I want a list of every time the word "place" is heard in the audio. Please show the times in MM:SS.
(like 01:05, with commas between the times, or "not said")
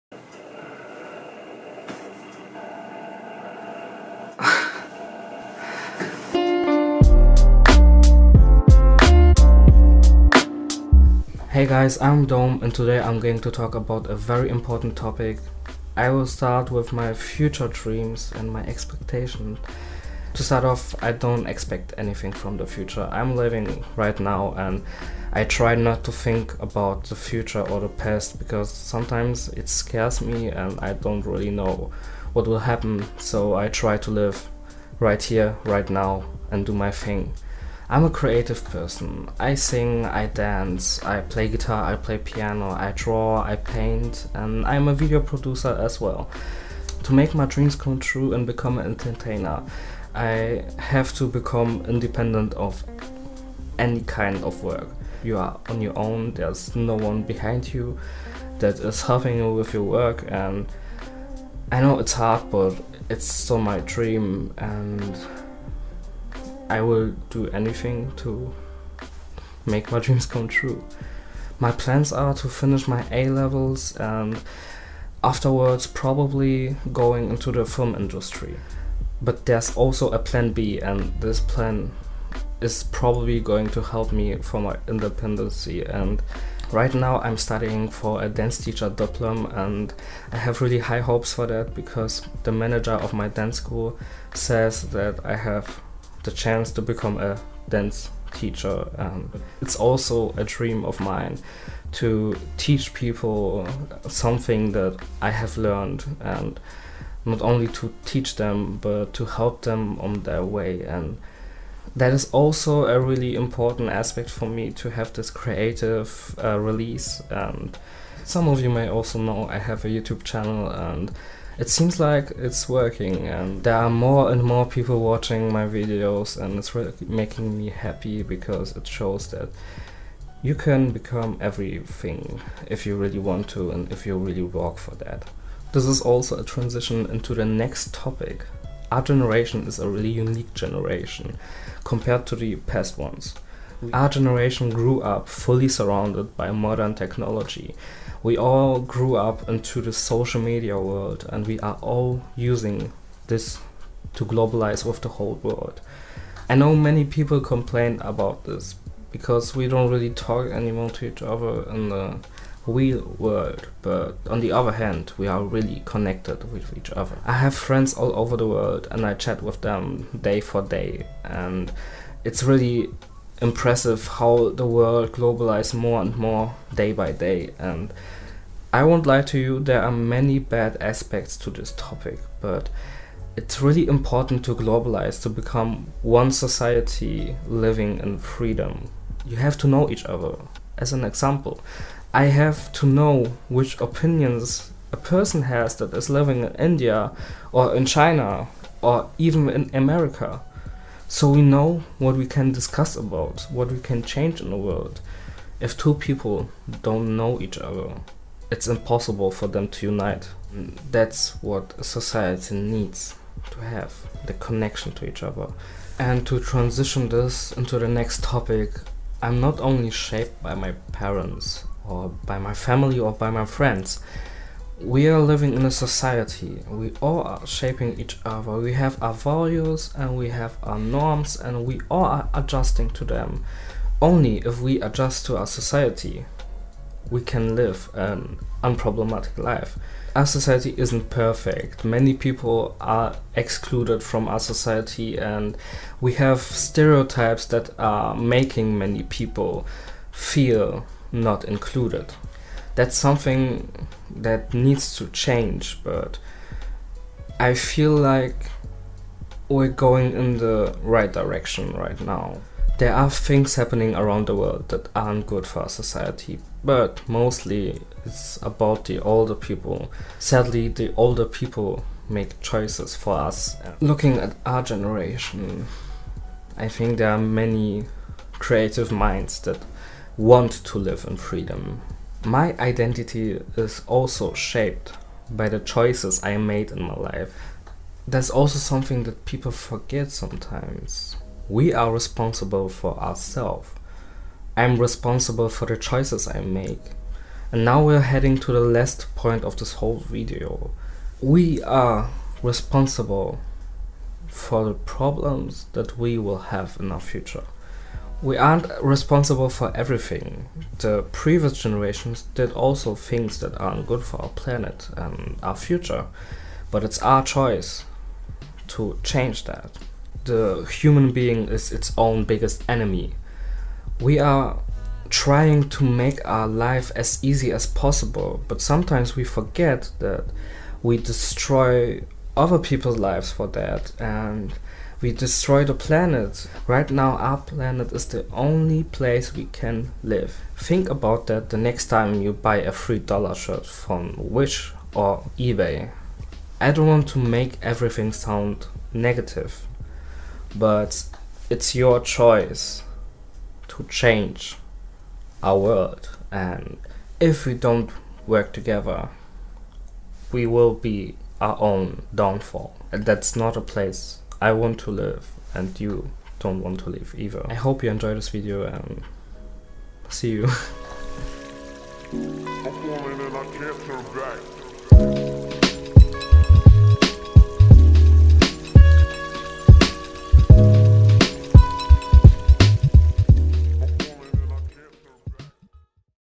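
05:38, 06:03.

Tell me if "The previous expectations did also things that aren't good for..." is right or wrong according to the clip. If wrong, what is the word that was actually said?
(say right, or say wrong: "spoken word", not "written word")
wrong: "generations", not "expectations".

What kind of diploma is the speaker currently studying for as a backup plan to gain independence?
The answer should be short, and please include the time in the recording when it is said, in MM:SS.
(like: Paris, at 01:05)
dance teacher diploma, at 01:28.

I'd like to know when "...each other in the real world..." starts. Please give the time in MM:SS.
02:41.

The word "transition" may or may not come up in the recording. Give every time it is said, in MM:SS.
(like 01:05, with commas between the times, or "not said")
02:16, 03:36.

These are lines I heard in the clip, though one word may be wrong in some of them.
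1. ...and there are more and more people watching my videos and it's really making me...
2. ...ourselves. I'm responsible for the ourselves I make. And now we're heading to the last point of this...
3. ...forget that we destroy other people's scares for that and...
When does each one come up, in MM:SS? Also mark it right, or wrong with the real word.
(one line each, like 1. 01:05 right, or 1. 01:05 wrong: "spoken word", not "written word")
1. 02:03 right
2. 04:52 wrong: "choices", not "ourselves"
3. 05:29 wrong: "lives", not "scares".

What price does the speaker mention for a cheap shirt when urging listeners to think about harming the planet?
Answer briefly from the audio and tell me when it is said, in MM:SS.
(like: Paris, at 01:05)
$3, at 05:42.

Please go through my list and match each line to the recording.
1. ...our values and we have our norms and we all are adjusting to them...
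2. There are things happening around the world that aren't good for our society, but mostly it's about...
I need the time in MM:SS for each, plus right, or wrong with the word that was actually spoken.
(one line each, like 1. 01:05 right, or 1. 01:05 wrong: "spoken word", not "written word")
1. 03:49 right
2. 04:22 right.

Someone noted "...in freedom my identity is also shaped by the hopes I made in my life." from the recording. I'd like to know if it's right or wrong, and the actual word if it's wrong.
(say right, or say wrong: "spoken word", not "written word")
wrong: "choices", not "hopes".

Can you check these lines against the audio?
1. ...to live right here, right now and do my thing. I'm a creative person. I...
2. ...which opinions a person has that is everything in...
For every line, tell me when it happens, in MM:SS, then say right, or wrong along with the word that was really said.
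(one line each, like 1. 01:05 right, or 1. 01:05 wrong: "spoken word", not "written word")
1. 00:33 right
2. 03:13 wrong: "living", not "everything".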